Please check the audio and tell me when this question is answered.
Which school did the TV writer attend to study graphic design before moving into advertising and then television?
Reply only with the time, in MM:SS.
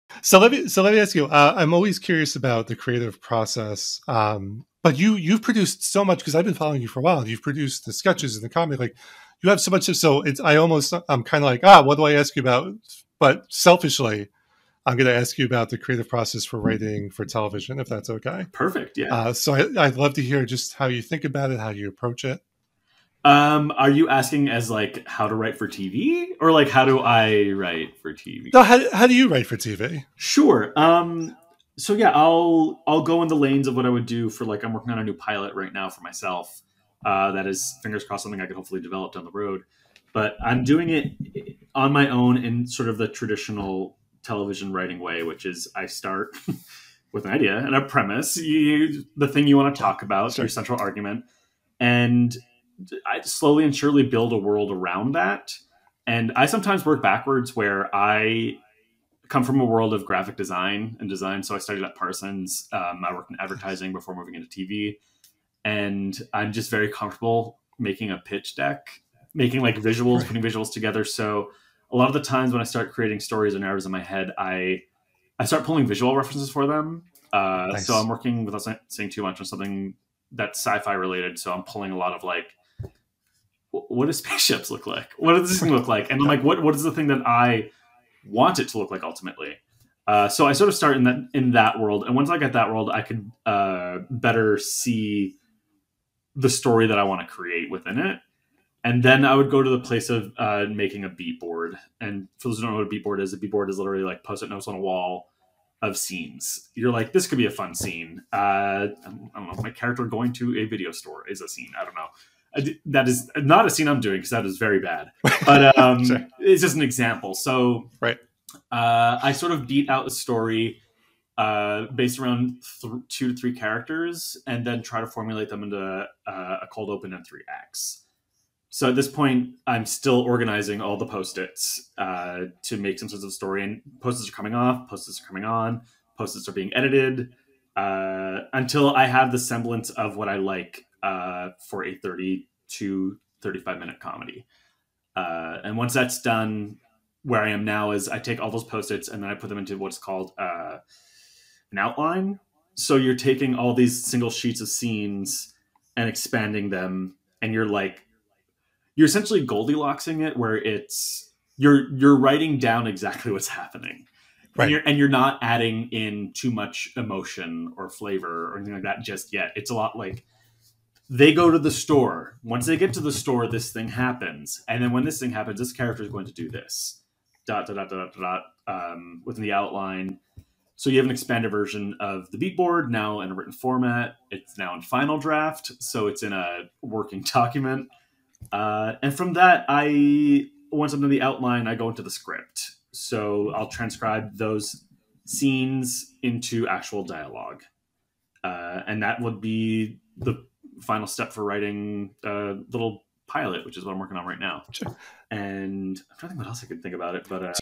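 01:01.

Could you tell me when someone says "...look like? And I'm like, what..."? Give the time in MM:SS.
01:25.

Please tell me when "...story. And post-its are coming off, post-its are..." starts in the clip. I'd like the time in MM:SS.
02:13.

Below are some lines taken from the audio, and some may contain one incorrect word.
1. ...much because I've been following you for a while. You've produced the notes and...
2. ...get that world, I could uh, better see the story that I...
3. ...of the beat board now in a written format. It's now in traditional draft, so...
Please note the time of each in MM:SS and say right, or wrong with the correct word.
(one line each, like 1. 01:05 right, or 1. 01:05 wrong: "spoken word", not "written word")
1. 00:06 wrong: "sketches", not "notes"
2. 01:32 right
3. 03:01 wrong: "final", not "traditional".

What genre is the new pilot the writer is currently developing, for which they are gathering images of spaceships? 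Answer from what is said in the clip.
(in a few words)
sci-fi.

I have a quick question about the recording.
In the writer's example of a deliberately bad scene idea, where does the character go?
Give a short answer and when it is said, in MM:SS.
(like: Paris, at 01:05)
a video store, at 01:50.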